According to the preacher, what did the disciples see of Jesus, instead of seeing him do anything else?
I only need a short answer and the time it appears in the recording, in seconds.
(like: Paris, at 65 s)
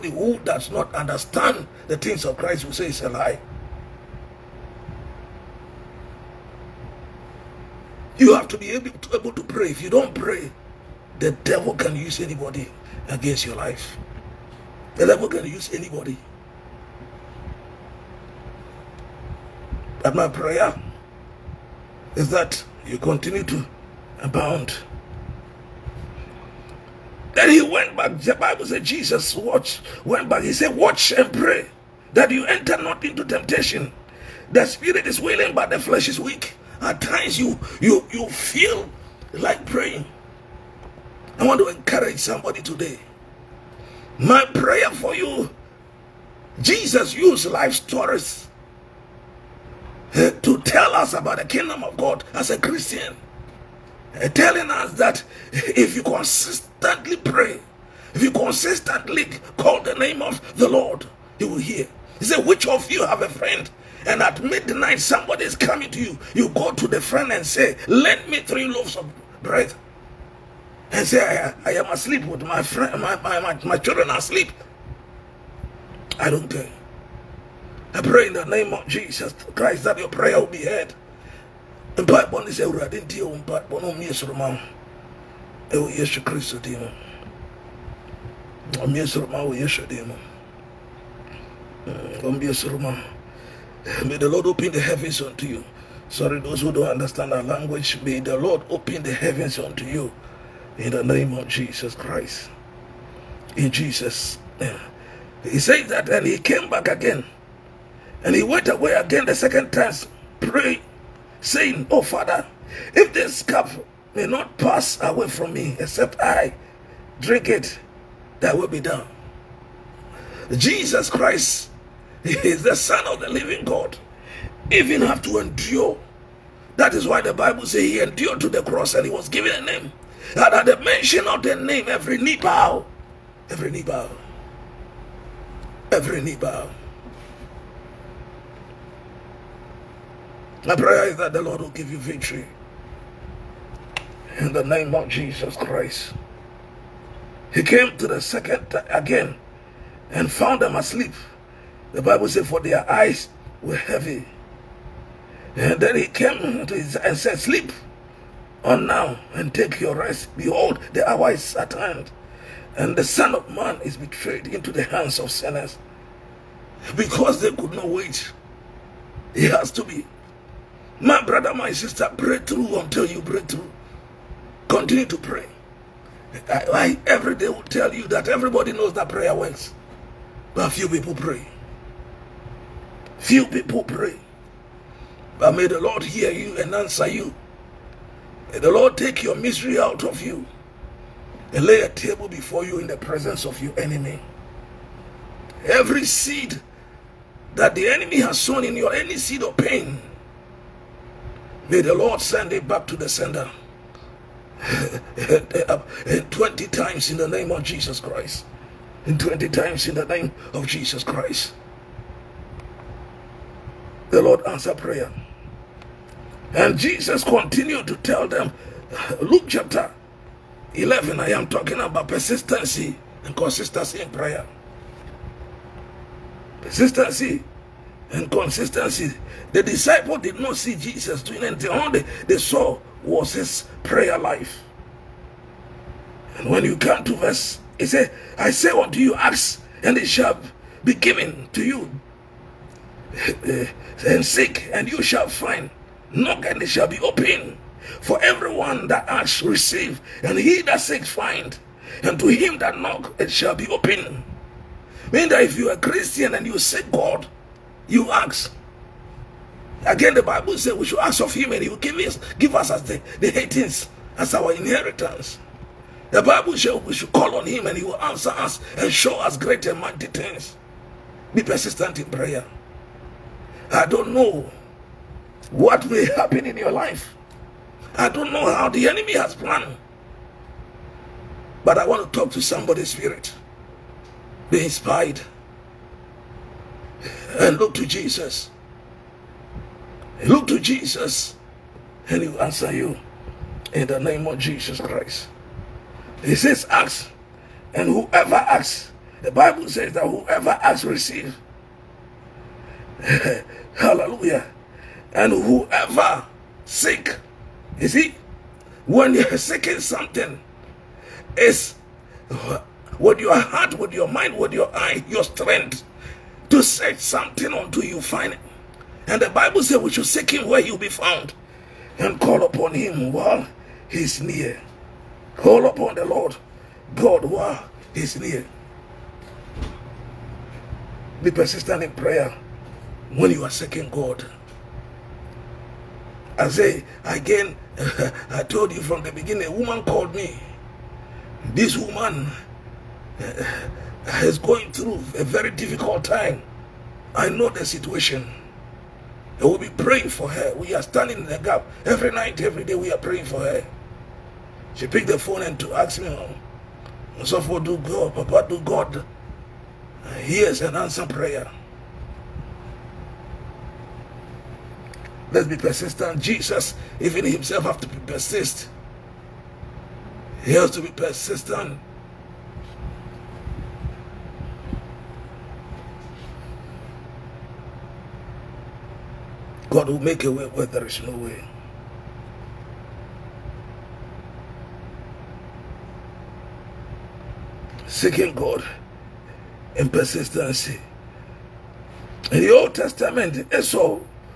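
His prayer life, at 233 s.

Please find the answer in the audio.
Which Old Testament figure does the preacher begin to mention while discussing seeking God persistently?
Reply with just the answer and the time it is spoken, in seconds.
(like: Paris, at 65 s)
Esau, at 393 s.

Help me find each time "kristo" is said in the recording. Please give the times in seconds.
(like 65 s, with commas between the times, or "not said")
86 s.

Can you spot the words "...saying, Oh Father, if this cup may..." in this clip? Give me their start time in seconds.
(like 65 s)
111 s.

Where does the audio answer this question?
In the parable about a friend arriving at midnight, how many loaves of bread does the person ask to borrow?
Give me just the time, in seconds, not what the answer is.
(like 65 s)
68 s.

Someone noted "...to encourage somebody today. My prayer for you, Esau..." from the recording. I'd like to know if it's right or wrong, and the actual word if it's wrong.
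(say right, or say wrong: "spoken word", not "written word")
wrong: "Jesus", not "Esau".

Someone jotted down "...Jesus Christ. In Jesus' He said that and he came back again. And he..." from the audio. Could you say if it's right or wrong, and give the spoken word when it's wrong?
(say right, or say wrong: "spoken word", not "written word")
right.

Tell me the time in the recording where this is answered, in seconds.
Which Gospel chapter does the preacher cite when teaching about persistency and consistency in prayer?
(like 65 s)
219 s.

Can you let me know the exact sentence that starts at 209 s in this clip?
And 20 times in the name of Jesus Christ.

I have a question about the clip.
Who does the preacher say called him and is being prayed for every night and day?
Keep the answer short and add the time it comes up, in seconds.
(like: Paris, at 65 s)
A woman, at 339 s.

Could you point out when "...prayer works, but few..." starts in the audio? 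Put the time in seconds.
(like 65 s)
179 s.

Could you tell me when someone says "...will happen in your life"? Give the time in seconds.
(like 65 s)
275 s.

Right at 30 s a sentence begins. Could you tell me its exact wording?
He said, watch and pray that you enter not into temptation.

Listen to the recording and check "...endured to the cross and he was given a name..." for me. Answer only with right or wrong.
right.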